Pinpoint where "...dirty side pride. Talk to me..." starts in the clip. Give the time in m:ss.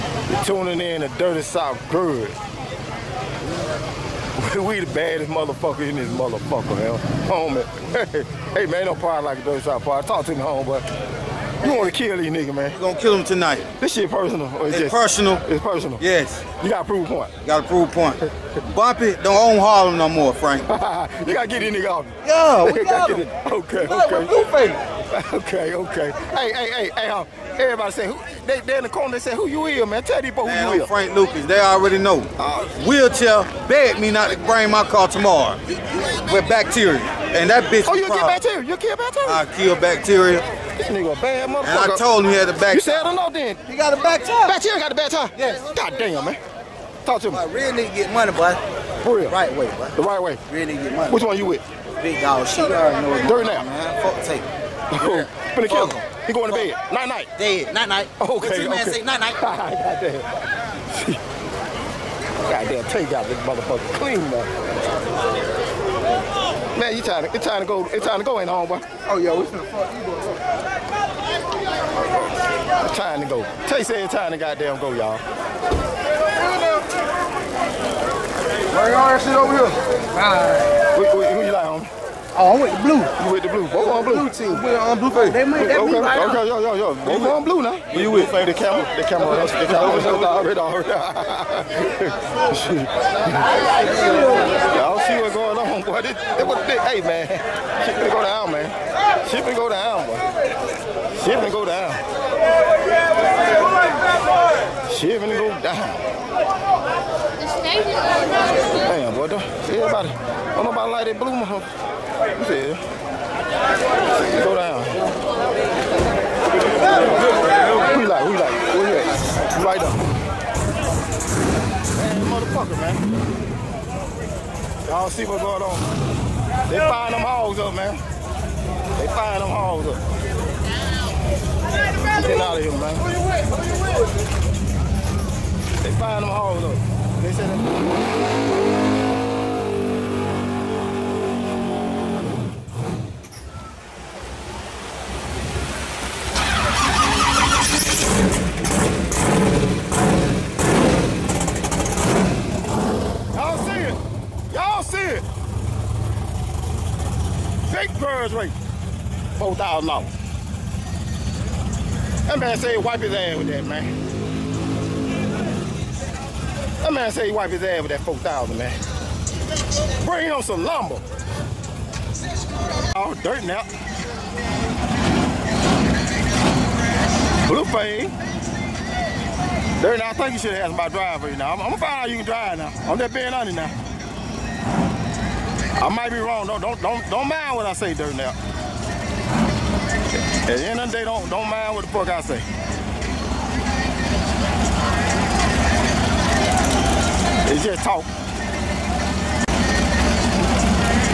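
0:09.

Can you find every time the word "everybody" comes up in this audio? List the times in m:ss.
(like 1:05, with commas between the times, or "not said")
0:27, 1:49.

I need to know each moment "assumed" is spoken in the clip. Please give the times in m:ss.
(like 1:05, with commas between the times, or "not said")
not said.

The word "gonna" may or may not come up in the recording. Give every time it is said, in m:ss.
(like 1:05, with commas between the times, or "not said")
0:12, 3:01.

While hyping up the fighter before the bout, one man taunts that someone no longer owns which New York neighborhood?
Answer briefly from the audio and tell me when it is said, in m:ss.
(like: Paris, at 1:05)
Harlem, at 0:19.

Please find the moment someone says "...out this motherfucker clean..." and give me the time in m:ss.
1:03.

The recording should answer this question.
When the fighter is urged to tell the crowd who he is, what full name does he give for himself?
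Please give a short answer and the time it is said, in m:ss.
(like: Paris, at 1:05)
Frank Lucas, at 0:30.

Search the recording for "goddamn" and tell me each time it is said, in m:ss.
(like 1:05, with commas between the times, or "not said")
1:14.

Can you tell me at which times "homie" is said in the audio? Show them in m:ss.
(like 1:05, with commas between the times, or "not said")
0:07, 1:21.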